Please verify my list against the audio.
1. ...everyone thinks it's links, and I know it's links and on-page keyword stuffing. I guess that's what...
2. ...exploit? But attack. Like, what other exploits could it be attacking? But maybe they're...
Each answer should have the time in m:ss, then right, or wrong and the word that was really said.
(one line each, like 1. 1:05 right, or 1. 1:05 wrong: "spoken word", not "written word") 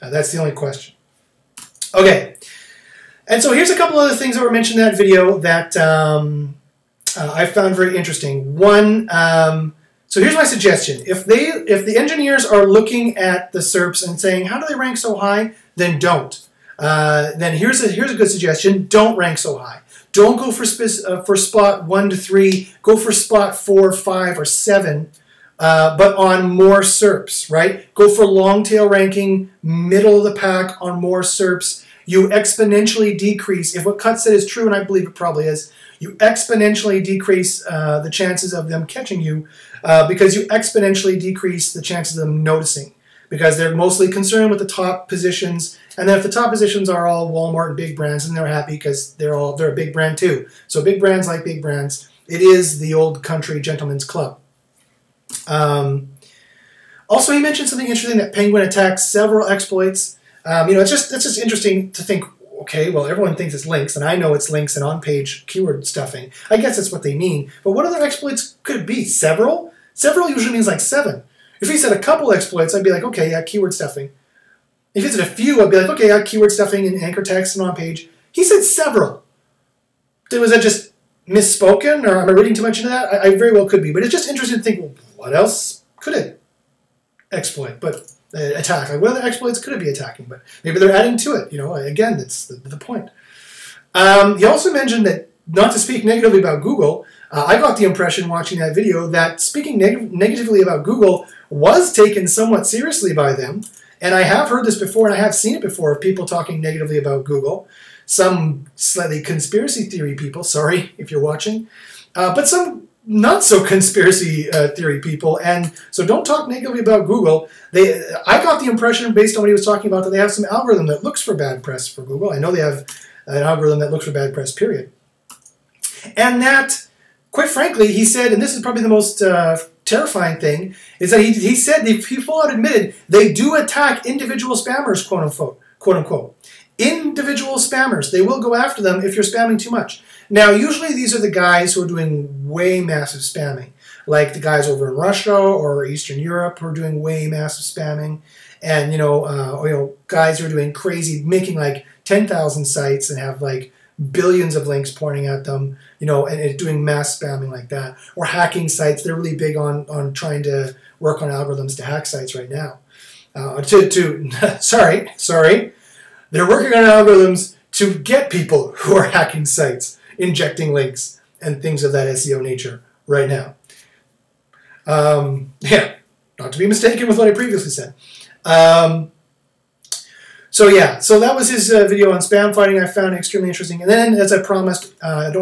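1. 1:03 right
2. 1:27 right.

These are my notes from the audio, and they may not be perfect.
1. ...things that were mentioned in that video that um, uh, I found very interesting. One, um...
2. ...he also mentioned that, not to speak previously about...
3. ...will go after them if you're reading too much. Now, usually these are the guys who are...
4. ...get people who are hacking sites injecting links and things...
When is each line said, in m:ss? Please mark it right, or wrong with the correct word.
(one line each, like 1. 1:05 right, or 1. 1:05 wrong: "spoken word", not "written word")
1. 0:04 right
2. 1:34 wrong: "negatively", not "previously"
3. 2:18 wrong: "spamming", not "reading"
4. 2:47 right.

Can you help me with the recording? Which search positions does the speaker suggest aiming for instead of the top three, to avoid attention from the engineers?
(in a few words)
4, 5, or 7.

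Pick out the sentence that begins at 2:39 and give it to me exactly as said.
They're really big on on trying to work on algorithms to hack sites right now.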